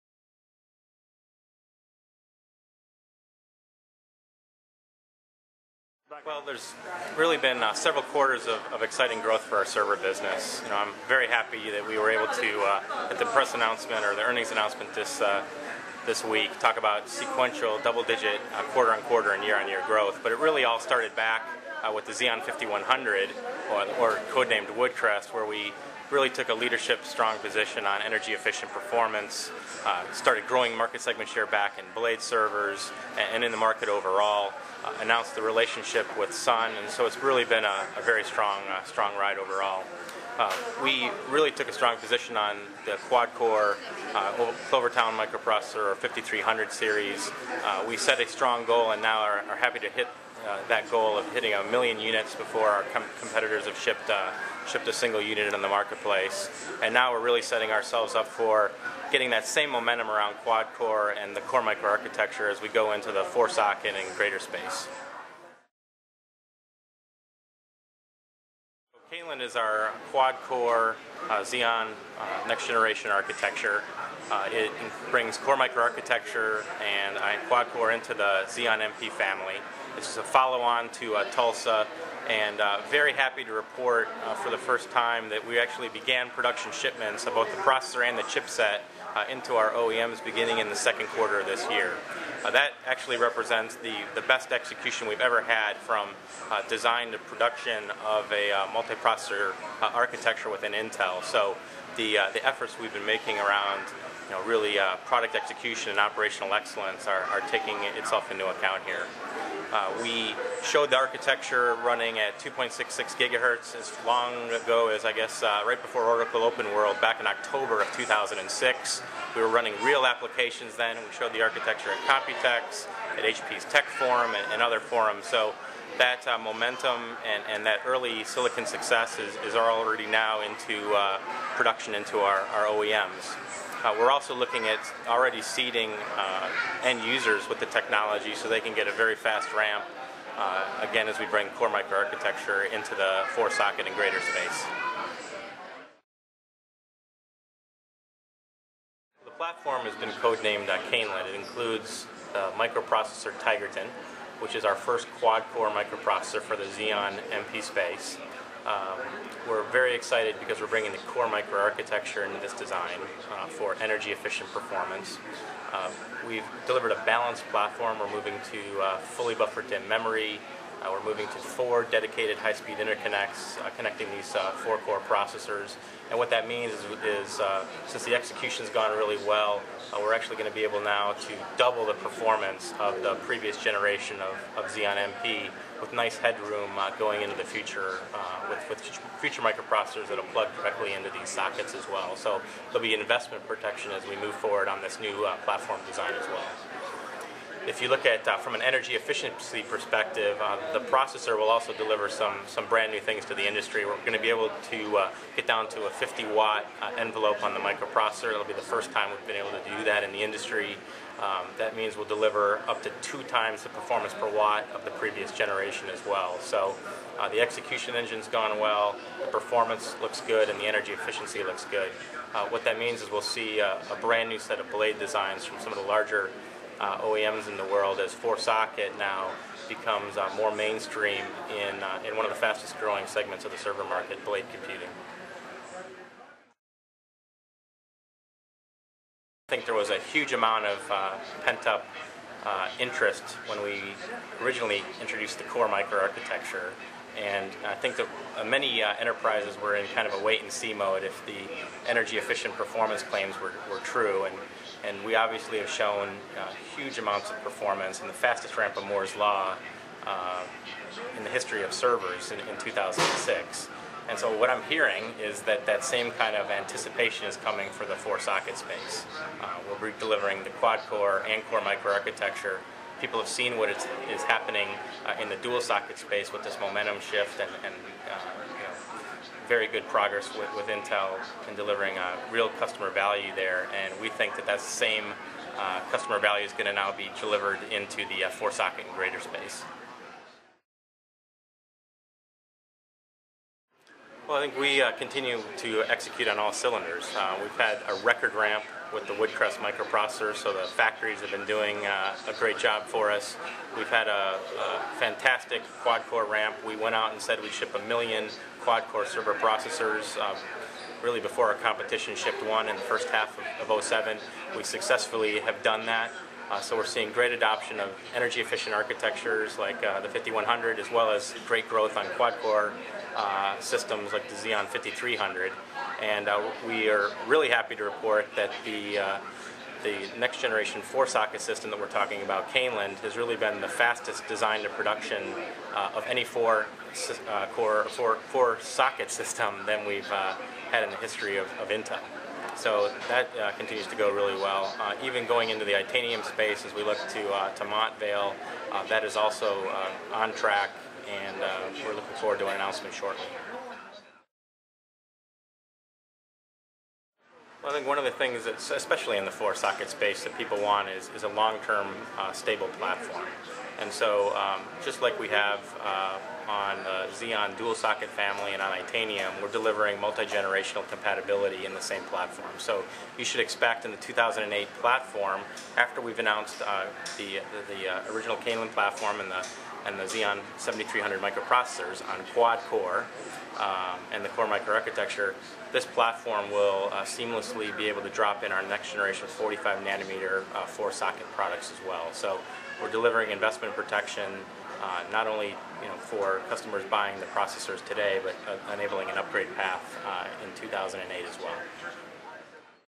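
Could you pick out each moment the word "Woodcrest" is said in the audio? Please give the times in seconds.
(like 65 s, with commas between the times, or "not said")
24 s, 299 s.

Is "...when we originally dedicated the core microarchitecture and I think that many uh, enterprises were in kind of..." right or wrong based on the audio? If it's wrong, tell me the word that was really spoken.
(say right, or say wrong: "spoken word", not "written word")
wrong: "introduced", not "dedicated".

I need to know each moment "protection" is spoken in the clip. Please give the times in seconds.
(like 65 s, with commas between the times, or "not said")
193 s, 393 s.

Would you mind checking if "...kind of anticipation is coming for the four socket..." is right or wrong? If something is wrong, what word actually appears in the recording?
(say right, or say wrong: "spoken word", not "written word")
right.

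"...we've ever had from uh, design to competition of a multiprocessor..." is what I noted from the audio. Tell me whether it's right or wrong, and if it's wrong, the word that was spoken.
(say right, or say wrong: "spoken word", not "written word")
wrong: "production", not "competition".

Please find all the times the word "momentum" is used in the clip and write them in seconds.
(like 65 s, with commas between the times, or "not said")
59 s, 126 s, 276 s.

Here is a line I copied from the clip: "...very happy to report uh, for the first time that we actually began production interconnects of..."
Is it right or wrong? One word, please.
wrong.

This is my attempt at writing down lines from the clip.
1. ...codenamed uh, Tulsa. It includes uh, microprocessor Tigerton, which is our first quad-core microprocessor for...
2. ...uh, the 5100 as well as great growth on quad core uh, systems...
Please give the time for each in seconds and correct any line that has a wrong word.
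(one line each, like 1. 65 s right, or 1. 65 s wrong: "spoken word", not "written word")
1. 150 s wrong: "Caneland", not "Tulsa"
2. 319 s right.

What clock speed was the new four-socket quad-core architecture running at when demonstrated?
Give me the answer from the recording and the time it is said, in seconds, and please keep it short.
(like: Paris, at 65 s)
2.66 gigahertz, at 112 s.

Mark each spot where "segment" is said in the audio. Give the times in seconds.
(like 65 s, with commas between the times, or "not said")
31 s, 233 s.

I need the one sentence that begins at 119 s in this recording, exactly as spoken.
We were running real applications then.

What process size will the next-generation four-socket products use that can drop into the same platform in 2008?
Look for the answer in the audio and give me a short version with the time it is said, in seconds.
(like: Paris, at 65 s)
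45 nanometer, at 389 s.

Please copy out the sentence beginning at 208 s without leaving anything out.
It'll be the first time we've been able to do that in the industry.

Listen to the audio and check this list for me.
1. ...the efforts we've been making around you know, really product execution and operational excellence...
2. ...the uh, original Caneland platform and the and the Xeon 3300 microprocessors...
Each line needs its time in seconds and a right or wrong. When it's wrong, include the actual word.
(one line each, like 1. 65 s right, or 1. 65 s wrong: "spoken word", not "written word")
1. 102 s right
2. 377 s wrong: "7300", not "3300".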